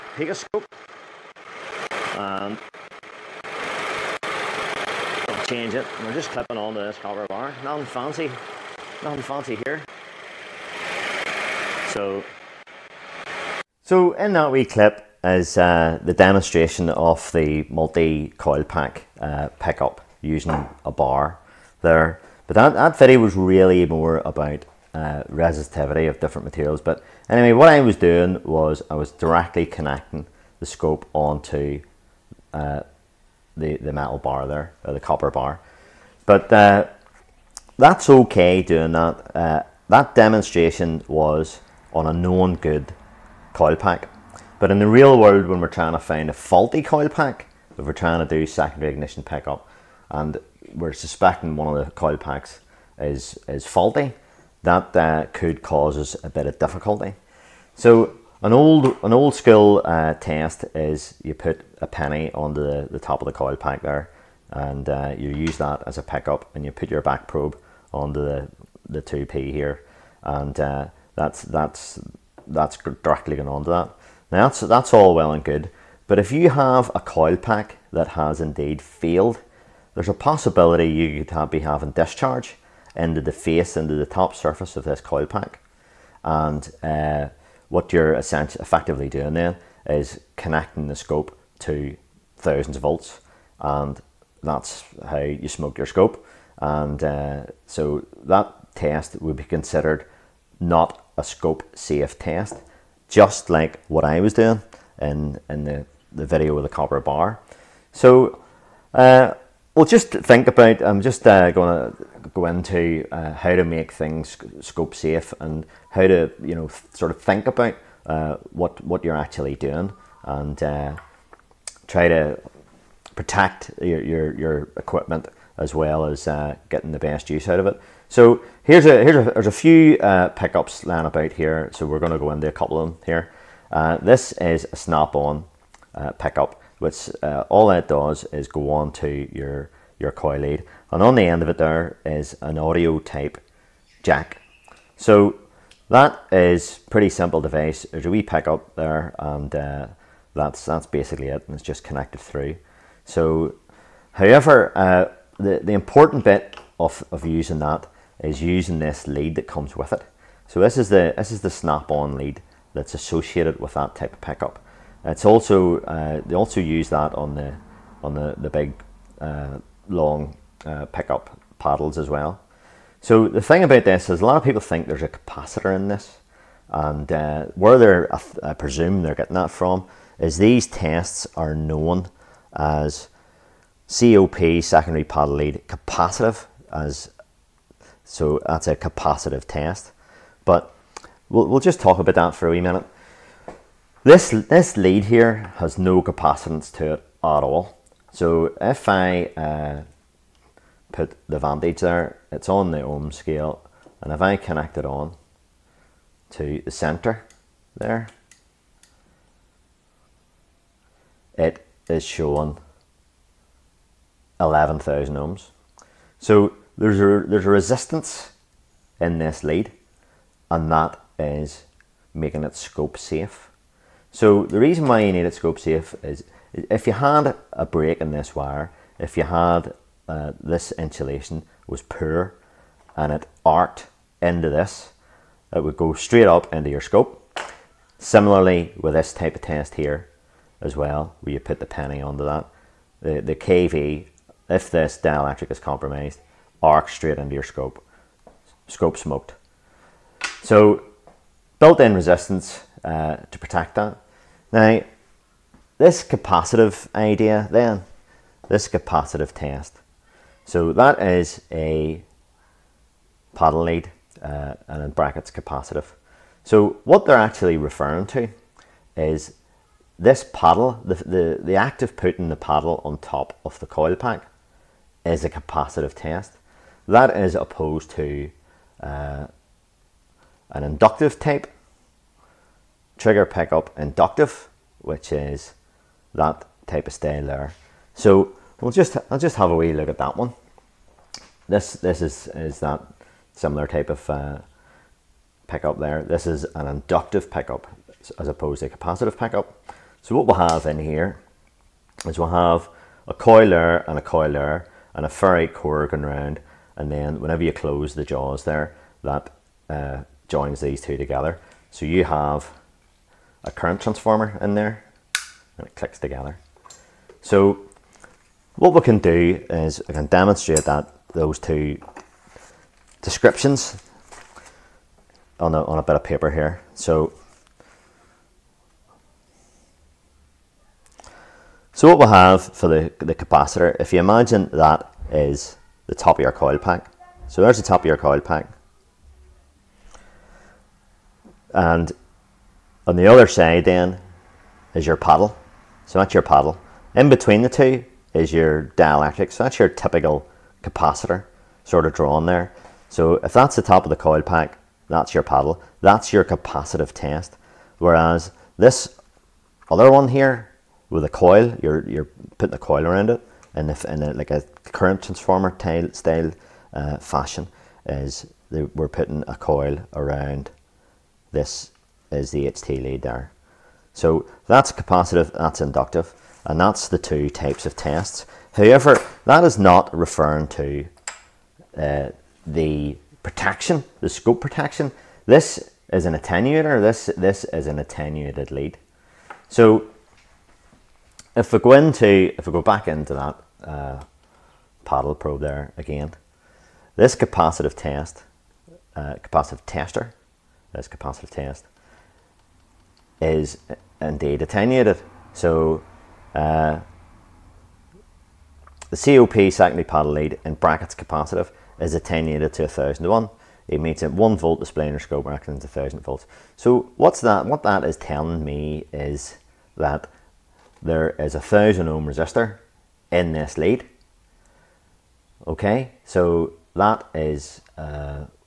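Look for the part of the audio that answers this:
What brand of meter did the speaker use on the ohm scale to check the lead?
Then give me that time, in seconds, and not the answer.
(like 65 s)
201 s.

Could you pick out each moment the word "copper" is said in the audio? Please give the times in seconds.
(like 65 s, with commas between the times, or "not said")
6 s, 35 s, 106 s.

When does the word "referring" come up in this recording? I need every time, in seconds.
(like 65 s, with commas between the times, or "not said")
267 s, 379 s.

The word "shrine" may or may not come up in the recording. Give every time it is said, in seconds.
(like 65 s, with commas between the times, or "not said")
not said.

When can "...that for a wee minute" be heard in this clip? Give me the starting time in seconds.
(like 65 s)
192 s.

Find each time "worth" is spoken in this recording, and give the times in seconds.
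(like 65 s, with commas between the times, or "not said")
not said.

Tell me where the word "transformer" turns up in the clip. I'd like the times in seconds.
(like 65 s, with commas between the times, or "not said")
313 s, 365 s.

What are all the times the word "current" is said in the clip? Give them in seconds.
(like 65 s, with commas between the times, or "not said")
313 s, 364 s.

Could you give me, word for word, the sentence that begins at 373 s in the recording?
So that's capacitive, that's inductive, and that's the two types of tests.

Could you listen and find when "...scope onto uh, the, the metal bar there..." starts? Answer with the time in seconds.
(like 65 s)
30 s.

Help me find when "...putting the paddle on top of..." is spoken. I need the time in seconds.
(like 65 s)
271 s.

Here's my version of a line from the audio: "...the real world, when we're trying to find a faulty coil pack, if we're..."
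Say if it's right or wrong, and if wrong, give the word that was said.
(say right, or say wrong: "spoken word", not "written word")
right.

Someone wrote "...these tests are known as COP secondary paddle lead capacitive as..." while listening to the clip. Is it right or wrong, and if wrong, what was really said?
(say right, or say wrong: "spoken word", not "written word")
right.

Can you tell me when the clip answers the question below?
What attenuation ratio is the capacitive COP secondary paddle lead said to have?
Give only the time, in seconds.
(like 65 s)
412 s.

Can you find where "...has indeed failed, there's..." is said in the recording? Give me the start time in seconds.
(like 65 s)
78 s.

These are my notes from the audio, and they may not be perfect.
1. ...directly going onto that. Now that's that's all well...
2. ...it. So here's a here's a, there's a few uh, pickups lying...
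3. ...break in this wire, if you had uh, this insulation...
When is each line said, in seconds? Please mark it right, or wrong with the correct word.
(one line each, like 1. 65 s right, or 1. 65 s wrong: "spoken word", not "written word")
1. 73 s right
2. 127 s right
3. 227 s right.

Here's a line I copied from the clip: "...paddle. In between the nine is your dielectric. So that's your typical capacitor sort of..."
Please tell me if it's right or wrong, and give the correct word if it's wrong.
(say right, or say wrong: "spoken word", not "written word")
wrong: "two", not "nine".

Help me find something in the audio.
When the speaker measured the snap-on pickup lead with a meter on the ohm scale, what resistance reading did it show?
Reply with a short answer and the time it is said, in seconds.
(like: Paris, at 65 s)
11,000 ohms, at 214 s.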